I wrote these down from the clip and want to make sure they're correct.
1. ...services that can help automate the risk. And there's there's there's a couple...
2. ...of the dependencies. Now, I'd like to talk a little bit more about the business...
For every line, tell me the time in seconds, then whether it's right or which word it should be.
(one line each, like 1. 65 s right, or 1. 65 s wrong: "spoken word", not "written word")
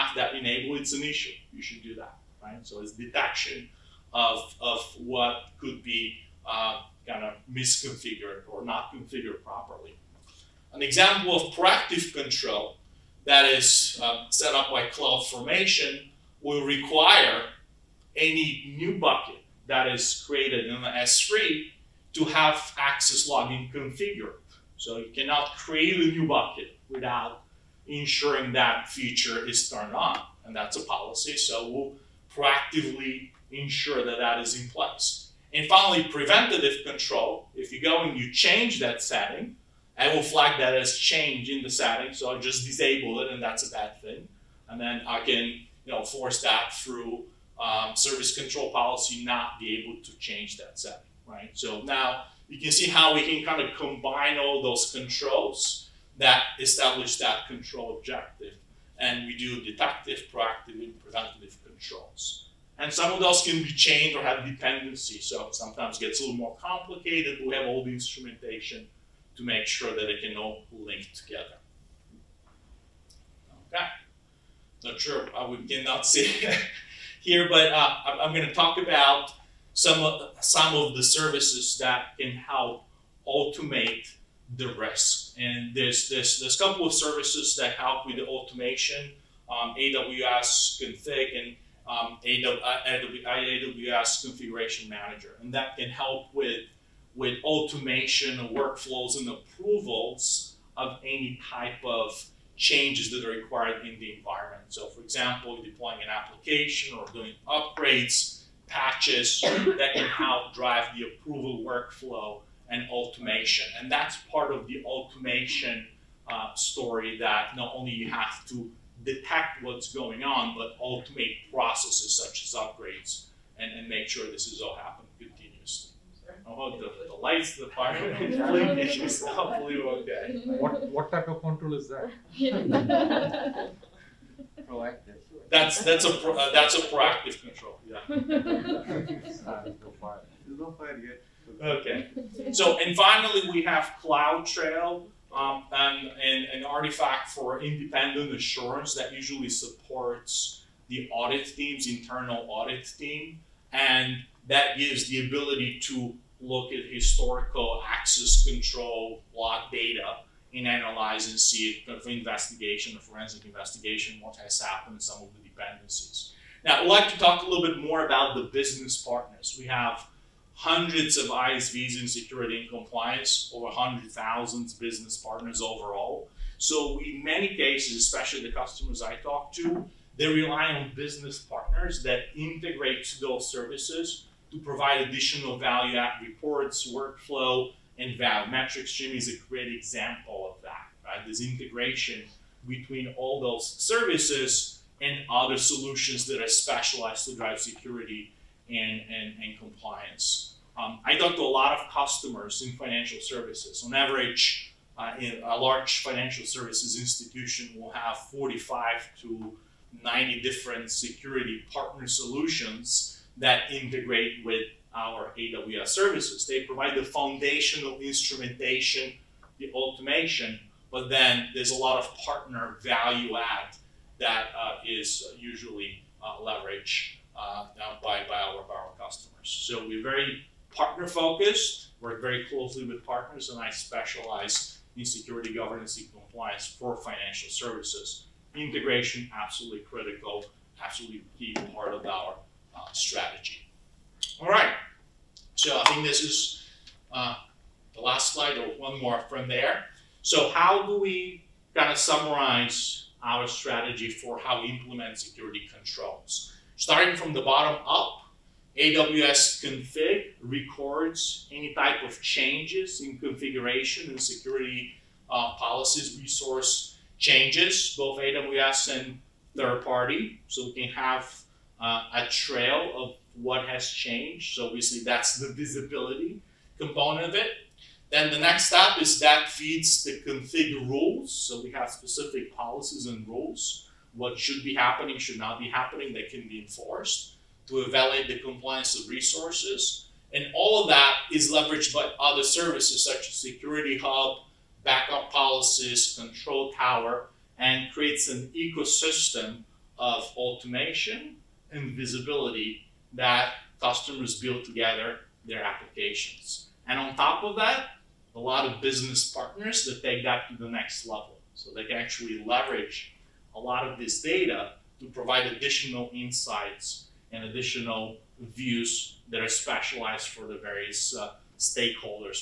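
1. 81 s right
2. 165 s right.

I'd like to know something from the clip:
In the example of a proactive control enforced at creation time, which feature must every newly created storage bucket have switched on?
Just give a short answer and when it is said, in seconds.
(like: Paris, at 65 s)
Access logging, at 22 s.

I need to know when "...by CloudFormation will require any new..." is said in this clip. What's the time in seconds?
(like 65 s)
14 s.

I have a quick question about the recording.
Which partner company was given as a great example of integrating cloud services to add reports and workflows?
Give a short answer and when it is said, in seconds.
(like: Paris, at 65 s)
Metrics Stream, at 188 s.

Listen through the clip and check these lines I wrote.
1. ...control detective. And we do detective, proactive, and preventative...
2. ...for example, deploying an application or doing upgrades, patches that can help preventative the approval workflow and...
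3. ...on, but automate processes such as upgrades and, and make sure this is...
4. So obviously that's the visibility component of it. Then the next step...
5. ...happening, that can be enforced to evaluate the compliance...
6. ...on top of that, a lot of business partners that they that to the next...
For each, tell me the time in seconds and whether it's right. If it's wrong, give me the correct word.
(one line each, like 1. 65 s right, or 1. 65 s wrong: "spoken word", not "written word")
1. 57 s wrong: "objective", not "detective"
2. 104 s wrong: "drive", not "preventative"
3. 120 s right
4. 274 s right
5. 285 s right
6. 306 s right.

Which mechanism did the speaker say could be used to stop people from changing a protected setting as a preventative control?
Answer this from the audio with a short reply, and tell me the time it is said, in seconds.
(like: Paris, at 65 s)
Service control policy, at 47 s.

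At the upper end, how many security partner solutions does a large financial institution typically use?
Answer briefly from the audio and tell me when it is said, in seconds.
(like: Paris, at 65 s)
90, at 210 s.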